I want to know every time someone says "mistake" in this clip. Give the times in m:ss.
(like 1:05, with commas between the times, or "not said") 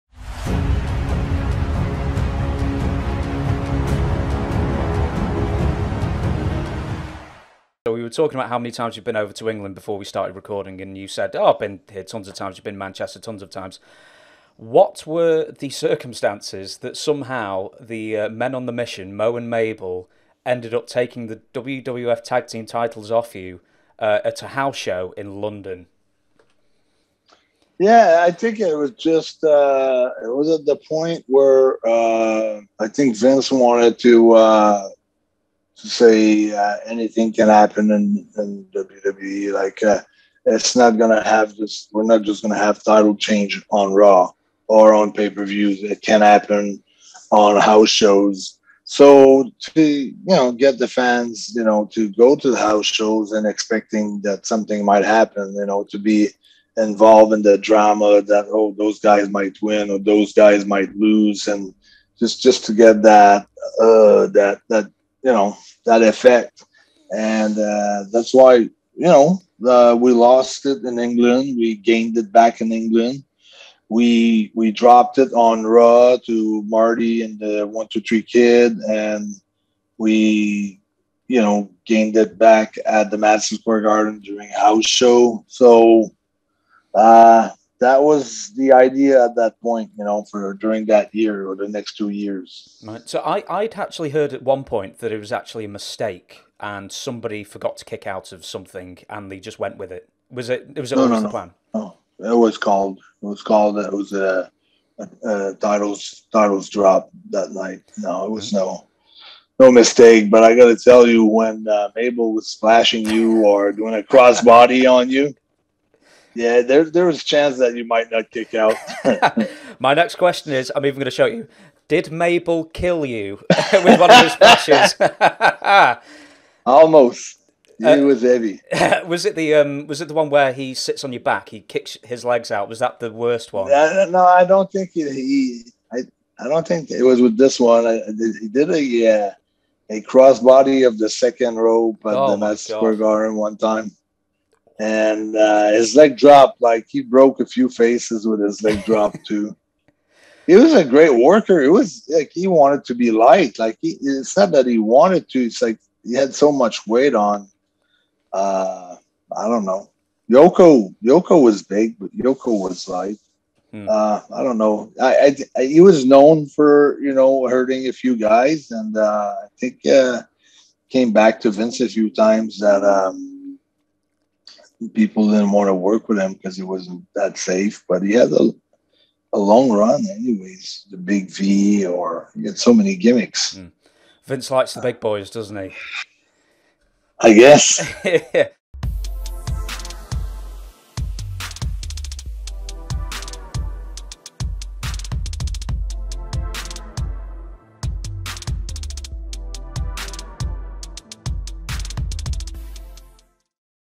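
1:35, 1:49.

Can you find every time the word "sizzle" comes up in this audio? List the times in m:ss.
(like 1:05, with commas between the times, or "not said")
not said.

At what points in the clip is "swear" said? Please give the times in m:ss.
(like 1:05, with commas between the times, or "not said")
2:22.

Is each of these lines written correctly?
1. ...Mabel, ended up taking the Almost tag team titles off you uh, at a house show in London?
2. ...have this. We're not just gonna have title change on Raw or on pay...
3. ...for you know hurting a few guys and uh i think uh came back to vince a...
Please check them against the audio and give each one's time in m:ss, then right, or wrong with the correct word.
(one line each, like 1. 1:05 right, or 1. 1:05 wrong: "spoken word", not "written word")
1. 0:19 wrong: "WWF", not "Almost"
2. 0:41 right
3. 2:46 right.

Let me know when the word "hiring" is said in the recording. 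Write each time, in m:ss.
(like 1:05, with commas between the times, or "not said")
not said.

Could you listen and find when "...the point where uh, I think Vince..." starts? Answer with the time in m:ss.
0:30.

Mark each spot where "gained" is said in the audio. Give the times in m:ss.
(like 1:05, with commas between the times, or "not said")
1:11, 1:21.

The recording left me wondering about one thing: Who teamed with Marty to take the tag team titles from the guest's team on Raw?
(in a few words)
The One Two Three Kid.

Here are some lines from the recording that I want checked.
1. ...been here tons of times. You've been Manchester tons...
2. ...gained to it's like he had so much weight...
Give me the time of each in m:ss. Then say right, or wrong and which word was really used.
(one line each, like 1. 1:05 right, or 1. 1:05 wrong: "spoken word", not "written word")
1. 0:11 right
2. 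2:34 wrong: "wanted", not "gained".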